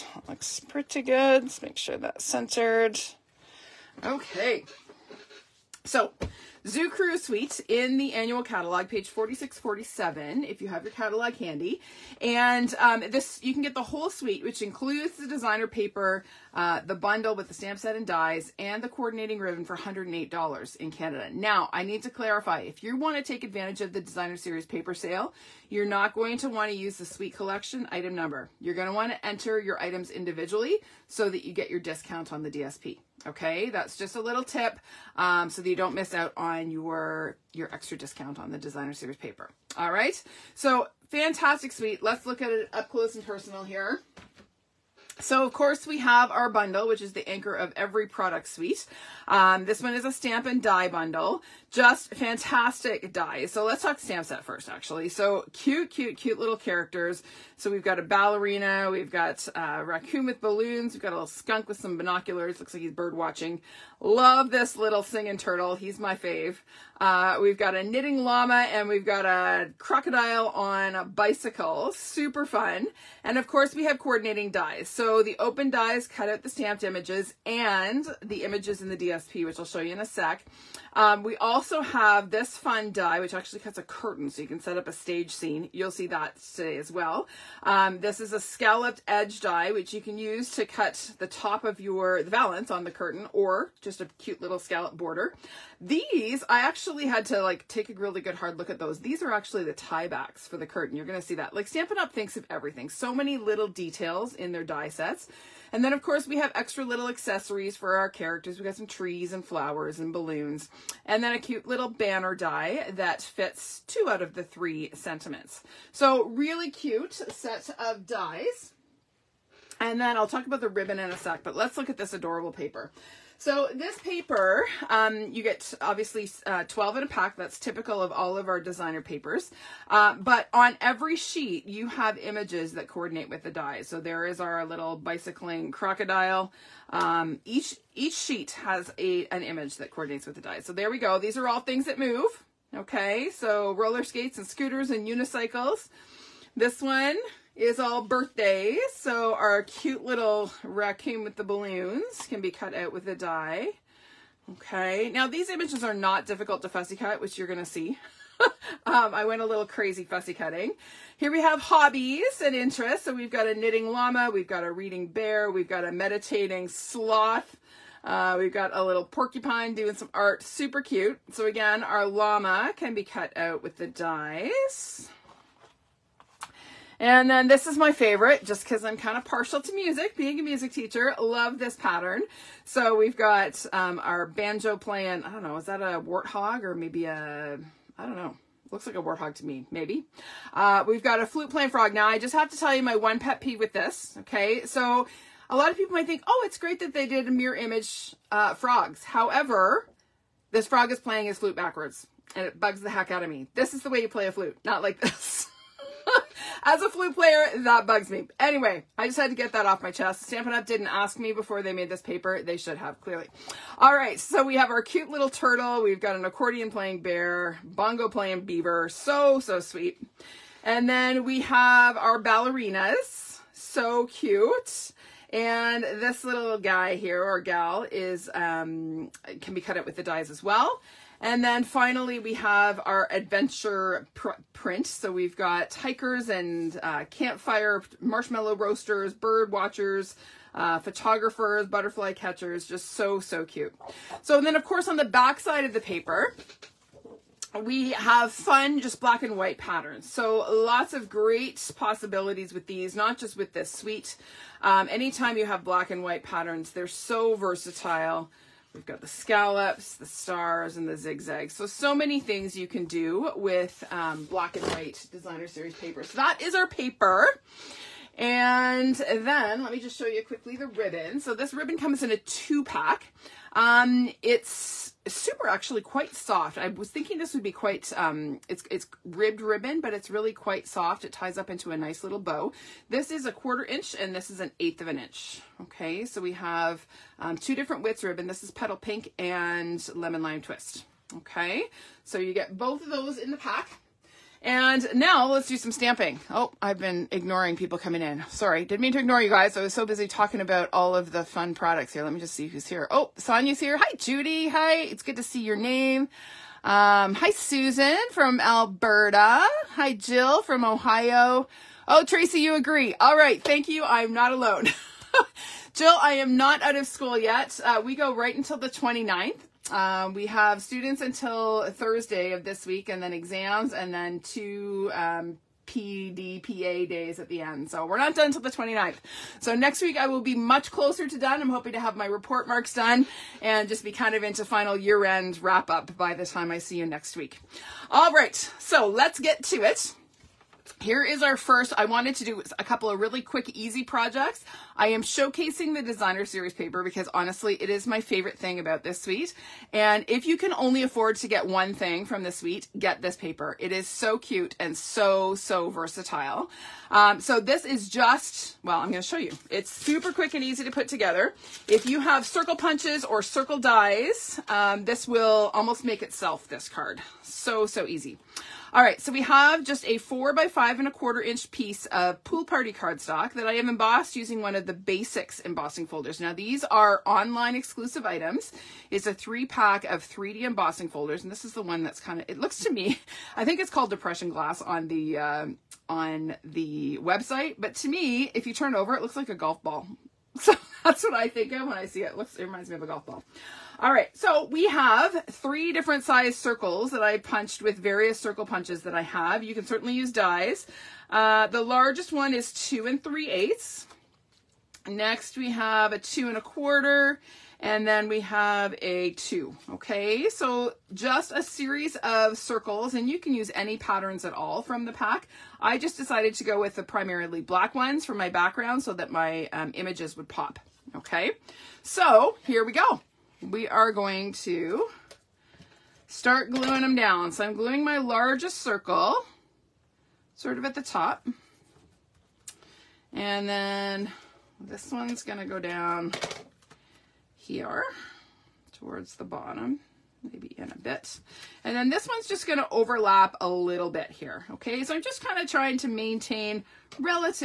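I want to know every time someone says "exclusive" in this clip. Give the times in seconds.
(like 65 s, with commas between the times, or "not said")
377 s.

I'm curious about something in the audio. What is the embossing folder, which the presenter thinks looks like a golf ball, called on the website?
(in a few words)
depression glass.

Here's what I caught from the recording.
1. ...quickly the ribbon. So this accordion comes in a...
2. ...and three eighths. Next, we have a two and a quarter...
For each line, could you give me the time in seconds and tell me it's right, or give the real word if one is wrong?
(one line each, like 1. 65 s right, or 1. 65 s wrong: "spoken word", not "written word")
1. 270 s wrong: "ribbon", not "accordion"
2. 402 s right.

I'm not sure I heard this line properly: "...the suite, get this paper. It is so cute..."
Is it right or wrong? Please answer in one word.
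right.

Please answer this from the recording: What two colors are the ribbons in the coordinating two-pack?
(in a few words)
Petal Pink and Lemon Lime Twist.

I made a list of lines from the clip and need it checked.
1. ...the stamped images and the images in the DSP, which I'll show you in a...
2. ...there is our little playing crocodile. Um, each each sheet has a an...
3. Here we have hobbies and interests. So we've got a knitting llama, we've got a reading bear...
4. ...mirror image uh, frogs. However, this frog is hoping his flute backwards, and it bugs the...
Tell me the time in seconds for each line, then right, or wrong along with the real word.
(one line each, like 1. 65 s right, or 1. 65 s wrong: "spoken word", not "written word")
1. 76 s right
2. 133 s wrong: "bicycling", not "playing"
3. 161 s right
4. 197 s wrong: "playing", not "hoping".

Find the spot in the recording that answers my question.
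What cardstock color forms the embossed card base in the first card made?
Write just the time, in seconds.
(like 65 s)
372 s.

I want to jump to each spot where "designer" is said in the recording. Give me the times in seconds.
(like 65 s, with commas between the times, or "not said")
15 s, 23 s, 38 s, 128 s, 265 s, 345 s.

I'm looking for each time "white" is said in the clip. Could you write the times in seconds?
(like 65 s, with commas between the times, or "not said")
249 s, 256 s, 264 s.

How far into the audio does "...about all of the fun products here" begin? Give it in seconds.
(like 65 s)
300 s.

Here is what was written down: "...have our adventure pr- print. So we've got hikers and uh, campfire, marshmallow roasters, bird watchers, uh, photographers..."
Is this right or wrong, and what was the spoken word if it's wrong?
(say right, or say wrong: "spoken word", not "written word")
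right.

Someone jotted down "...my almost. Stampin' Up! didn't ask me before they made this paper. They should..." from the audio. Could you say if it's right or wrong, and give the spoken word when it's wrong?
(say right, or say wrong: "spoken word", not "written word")
wrong: "chest", not "almost".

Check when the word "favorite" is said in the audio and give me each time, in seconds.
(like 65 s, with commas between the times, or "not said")
177 s, 347 s.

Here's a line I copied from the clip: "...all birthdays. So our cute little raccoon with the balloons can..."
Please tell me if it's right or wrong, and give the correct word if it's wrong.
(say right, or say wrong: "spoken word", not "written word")
right.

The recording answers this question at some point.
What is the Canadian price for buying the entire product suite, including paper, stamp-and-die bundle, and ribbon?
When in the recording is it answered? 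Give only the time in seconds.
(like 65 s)
19 s.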